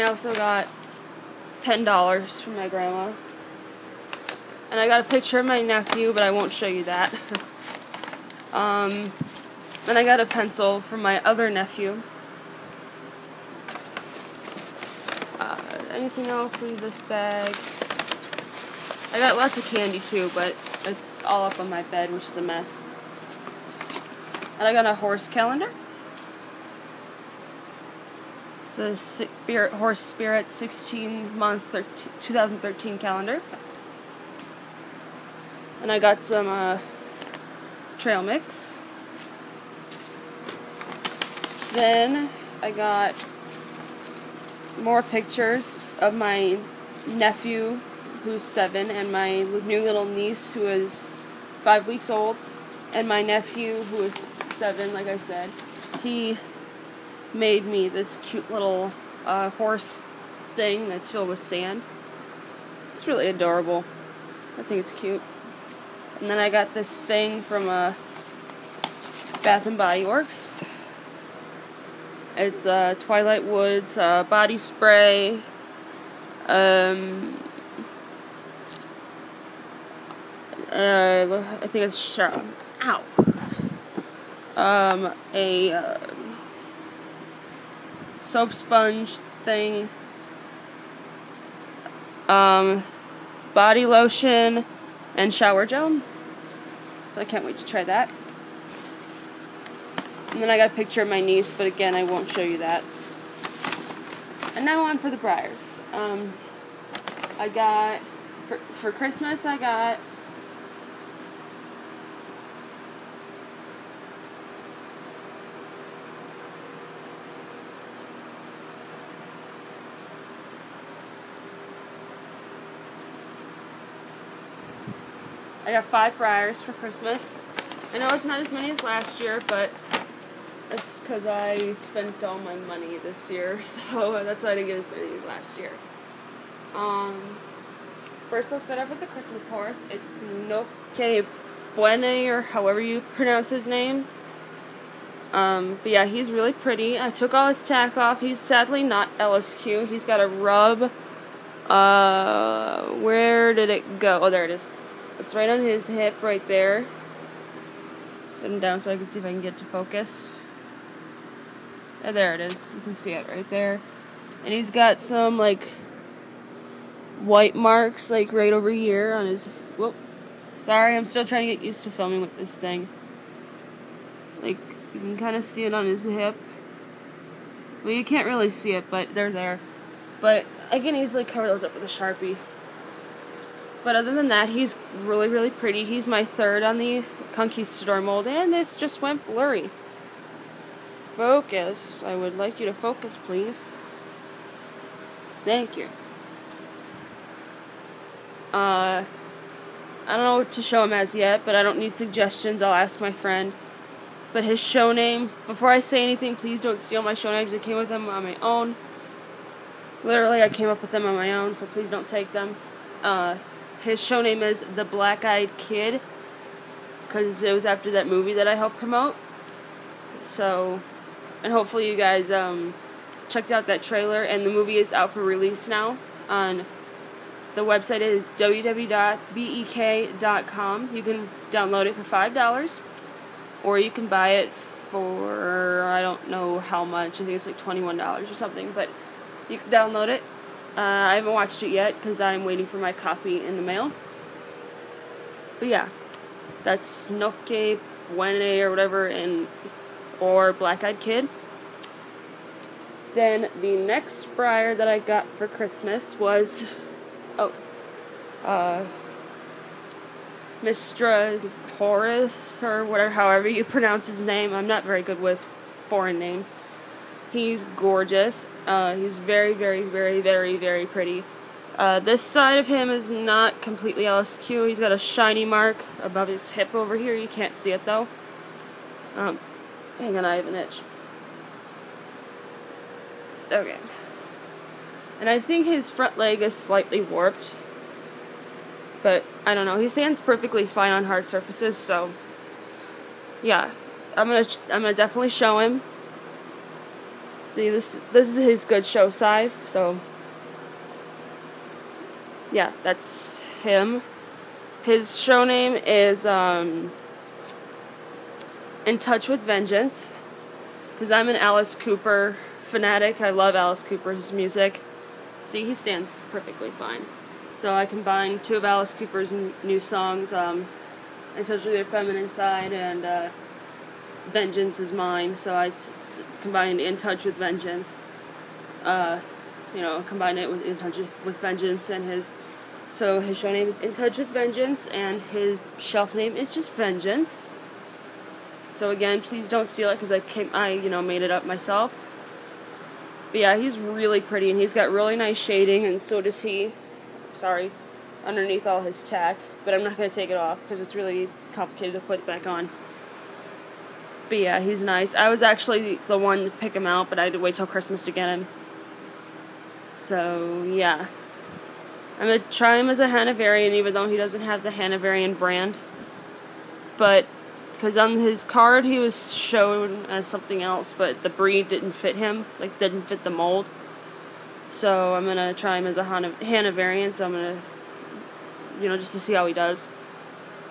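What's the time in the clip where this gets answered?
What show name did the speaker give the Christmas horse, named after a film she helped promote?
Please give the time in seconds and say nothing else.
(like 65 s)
214 s.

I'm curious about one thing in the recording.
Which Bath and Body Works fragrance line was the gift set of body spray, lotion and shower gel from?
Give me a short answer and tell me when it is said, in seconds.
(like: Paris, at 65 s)
Twilight Woods, at 72 s.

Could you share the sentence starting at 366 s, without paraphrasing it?
But, because on his card he was shown as something else, but the breed didn't fit him, like, didn't fit the mold.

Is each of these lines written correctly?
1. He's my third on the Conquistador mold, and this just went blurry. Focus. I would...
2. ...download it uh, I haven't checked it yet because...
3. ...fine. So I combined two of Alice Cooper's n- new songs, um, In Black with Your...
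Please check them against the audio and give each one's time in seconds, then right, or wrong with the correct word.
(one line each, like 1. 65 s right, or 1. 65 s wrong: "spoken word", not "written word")
1. 185 s right
2. 239 s wrong: "watched", not "checked"
3. 316 s wrong: "Touch", not "Black".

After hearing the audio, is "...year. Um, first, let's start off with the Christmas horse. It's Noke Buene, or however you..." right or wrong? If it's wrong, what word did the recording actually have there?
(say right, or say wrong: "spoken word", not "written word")
right.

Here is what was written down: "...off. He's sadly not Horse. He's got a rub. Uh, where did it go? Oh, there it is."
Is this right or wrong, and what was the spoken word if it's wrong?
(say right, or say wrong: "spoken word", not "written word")
wrong: "LSQ", not "Horse".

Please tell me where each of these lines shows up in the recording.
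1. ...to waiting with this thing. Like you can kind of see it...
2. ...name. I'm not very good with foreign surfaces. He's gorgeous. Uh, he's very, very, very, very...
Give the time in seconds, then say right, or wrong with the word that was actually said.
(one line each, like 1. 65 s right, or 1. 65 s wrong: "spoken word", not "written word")
1. 171 s wrong: "filming", not "waiting"
2. 264 s wrong: "names", not "surfaces".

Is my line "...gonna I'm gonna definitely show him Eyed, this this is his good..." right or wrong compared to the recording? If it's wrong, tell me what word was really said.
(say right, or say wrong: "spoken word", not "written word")
wrong: "See", not "Eyed".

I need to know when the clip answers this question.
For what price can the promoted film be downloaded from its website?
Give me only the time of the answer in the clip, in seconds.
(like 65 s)
232 s.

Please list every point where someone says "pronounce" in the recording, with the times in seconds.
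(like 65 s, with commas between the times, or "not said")
143 s, 263 s.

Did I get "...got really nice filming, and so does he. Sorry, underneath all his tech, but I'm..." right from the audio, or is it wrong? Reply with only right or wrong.
wrong.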